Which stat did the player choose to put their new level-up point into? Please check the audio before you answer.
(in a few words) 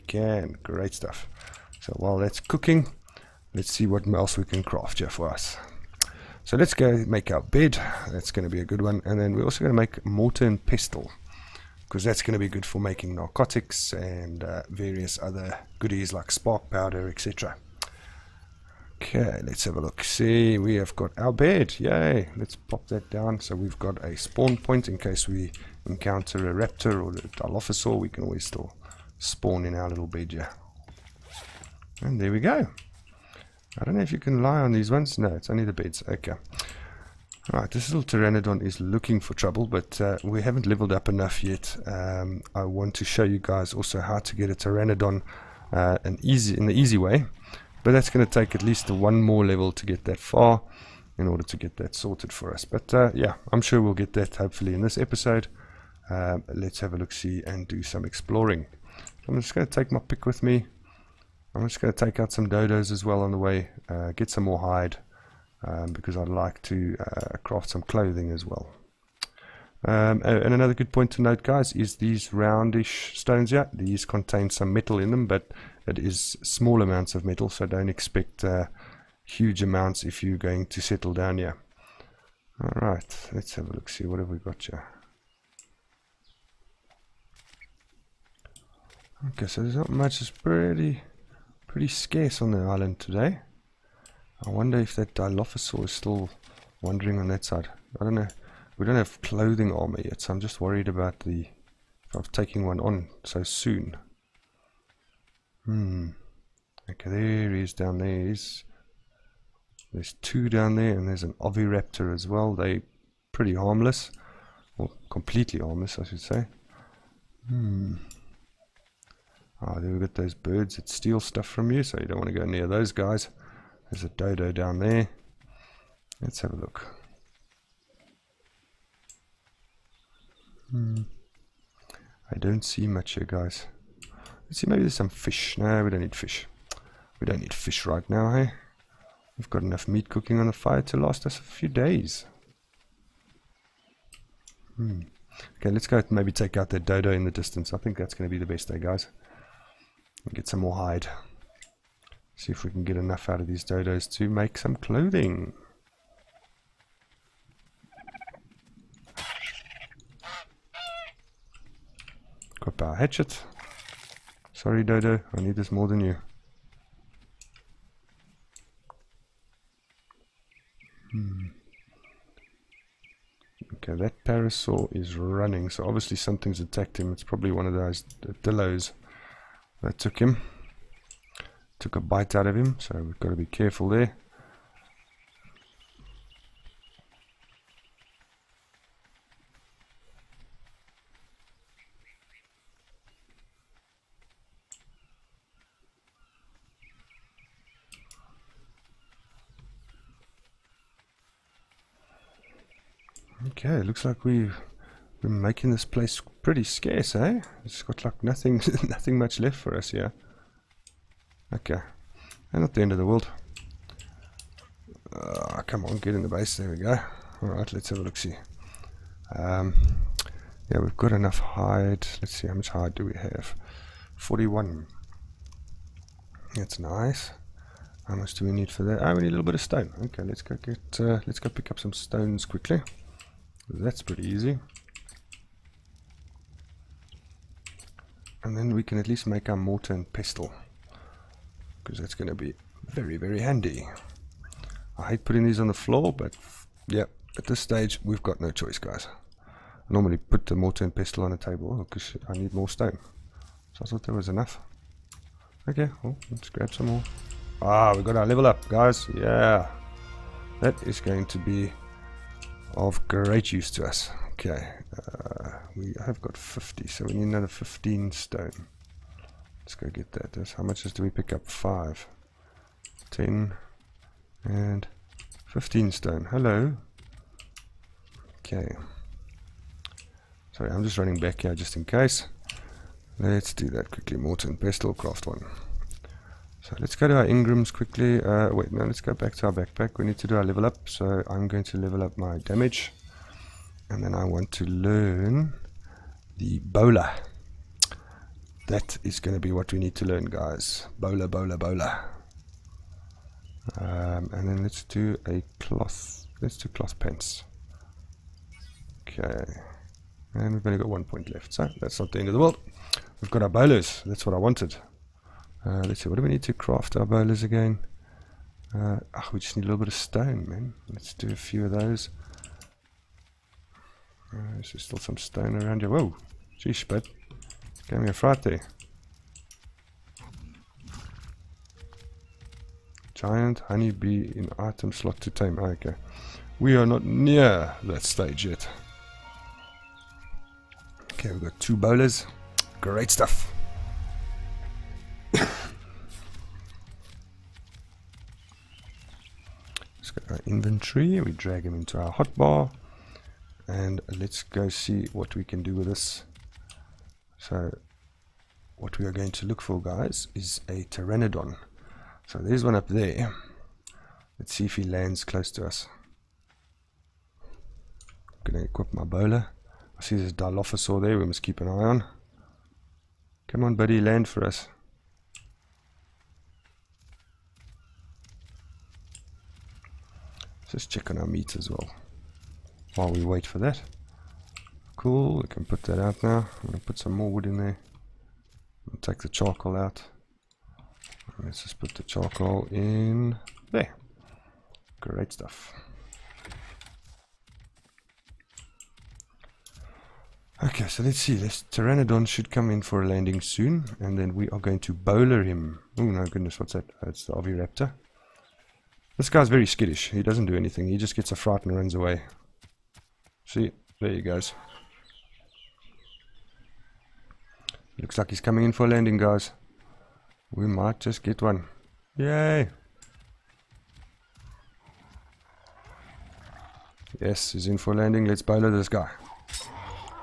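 Damage.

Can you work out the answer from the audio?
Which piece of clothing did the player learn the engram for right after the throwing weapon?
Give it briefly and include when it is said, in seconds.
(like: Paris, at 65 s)
Cloth pants, at 306 s.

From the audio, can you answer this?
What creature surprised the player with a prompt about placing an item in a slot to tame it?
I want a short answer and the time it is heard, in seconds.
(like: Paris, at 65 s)
Giant honeybee, at 333 s.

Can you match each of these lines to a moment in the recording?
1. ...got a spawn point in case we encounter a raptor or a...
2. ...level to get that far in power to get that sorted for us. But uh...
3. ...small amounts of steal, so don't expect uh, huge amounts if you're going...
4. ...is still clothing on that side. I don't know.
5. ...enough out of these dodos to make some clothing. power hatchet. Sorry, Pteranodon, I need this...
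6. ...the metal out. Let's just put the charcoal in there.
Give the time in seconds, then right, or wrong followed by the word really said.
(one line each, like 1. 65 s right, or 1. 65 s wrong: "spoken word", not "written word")
1. 23 s right
2. 49 s wrong: "order", not "power"
3. 76 s wrong: "metal", not "steal"
4. 95 s wrong: "wandering", not "clothing"
5. 152 s wrong: "Dodo", not "Pteranodon"
6. 389 s wrong: "charcoal", not "metal".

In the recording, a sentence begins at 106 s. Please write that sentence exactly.
Okay, there he is down there.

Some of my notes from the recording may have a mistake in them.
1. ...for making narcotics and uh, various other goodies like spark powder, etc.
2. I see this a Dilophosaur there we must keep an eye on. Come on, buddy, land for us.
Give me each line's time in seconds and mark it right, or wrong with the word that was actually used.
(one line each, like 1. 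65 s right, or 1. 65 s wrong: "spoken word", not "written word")
1. 12 s right
2. 369 s right.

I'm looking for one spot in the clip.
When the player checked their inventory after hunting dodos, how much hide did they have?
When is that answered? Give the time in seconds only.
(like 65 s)
224 s.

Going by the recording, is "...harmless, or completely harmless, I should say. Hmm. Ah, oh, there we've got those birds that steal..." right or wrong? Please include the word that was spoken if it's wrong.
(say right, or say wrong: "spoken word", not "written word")
right.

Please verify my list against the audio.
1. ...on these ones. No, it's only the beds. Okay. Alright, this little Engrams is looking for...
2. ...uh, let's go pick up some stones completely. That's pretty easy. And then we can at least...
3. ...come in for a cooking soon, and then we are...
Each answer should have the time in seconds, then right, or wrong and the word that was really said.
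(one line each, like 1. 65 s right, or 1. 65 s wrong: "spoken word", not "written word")
1. 34 s wrong: "Pteranodon", not "Engrams"
2. 230 s wrong: "quickly", not "completely"
3. 402 s wrong: "landing", not "cooking".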